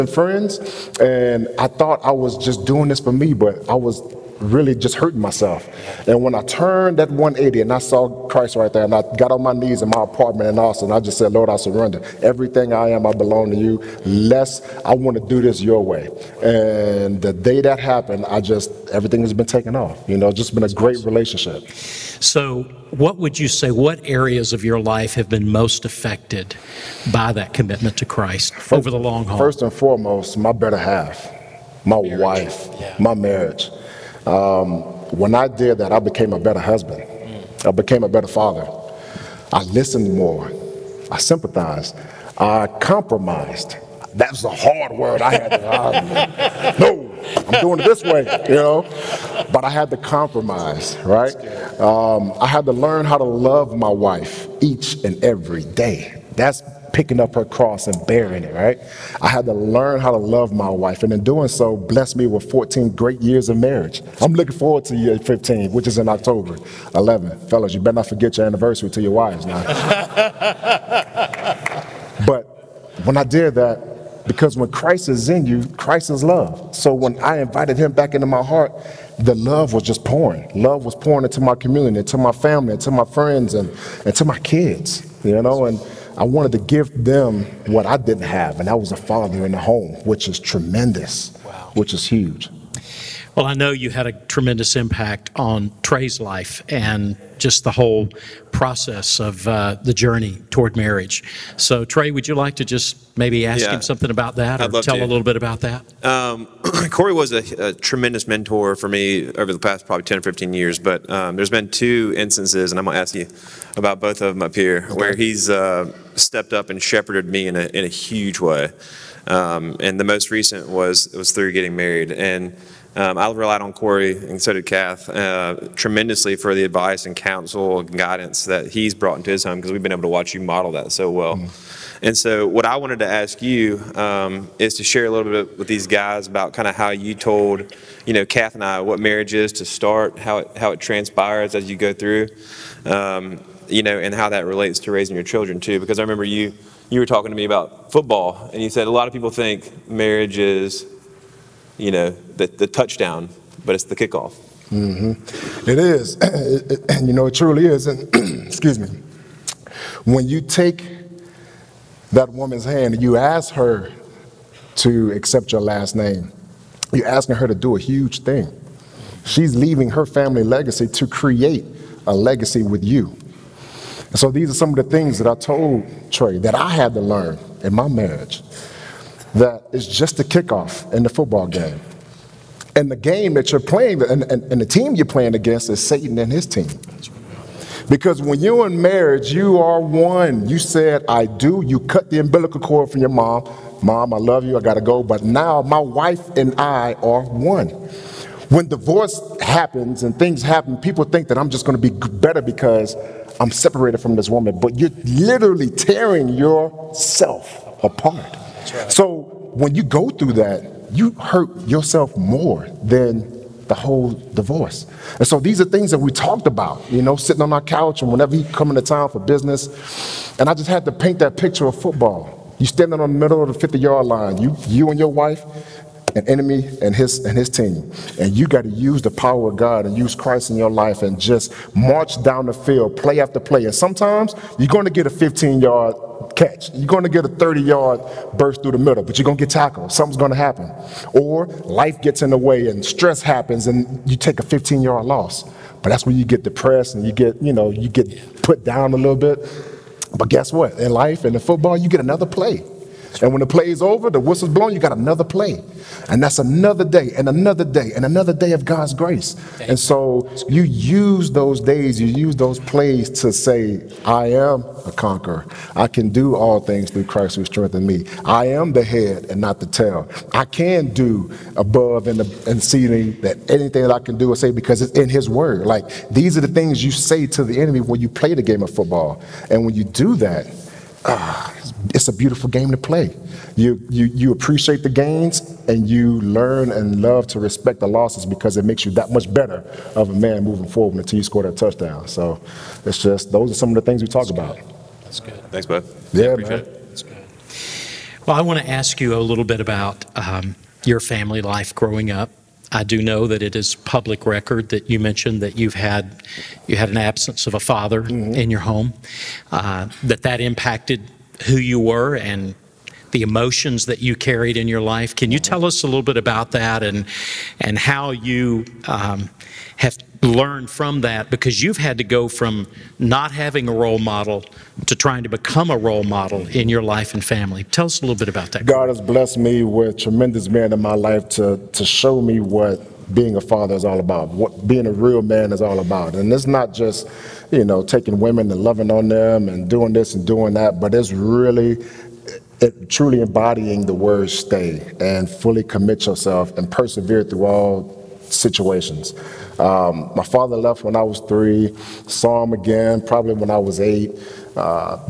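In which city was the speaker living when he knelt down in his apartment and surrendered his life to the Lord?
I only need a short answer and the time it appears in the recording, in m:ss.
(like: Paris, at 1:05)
Austin, at 0:10.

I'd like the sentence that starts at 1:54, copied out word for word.
where he's uh, stepped up and shepherded me in a, in a huge way.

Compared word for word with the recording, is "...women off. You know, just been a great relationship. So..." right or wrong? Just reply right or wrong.
wrong.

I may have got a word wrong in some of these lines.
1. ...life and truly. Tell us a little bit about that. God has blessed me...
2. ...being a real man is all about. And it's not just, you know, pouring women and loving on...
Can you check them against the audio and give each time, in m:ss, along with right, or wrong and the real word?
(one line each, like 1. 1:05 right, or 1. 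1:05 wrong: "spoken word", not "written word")
1. 5:26 wrong: "family", not "truly"
2. 5:34 wrong: "taking", not "pouring".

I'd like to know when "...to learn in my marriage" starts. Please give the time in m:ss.
2:56.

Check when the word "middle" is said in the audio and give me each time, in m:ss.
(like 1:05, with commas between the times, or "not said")
3:43, 3:58.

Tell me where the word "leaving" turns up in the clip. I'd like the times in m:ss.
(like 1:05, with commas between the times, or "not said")
2:49.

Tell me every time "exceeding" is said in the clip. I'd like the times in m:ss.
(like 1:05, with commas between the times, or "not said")
4:32.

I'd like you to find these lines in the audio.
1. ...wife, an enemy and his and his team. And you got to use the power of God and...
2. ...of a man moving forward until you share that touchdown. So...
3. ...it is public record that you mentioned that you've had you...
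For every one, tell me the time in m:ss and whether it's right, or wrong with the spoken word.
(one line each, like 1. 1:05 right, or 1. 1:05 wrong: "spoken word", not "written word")
1. 3:45 right
2. 4:49 wrong: "score", not "share"
3. 5:03 right.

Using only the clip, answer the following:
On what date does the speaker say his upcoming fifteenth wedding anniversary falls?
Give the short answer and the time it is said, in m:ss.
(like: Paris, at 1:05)
October 11, at 1:06.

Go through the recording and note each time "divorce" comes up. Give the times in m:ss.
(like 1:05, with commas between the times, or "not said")
3:18, 3:34.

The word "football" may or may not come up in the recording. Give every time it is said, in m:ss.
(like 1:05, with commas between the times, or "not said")
2:27, 3:01, 3:41, 4:11, 4:38.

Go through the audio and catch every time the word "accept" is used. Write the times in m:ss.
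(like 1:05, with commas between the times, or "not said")
2:45.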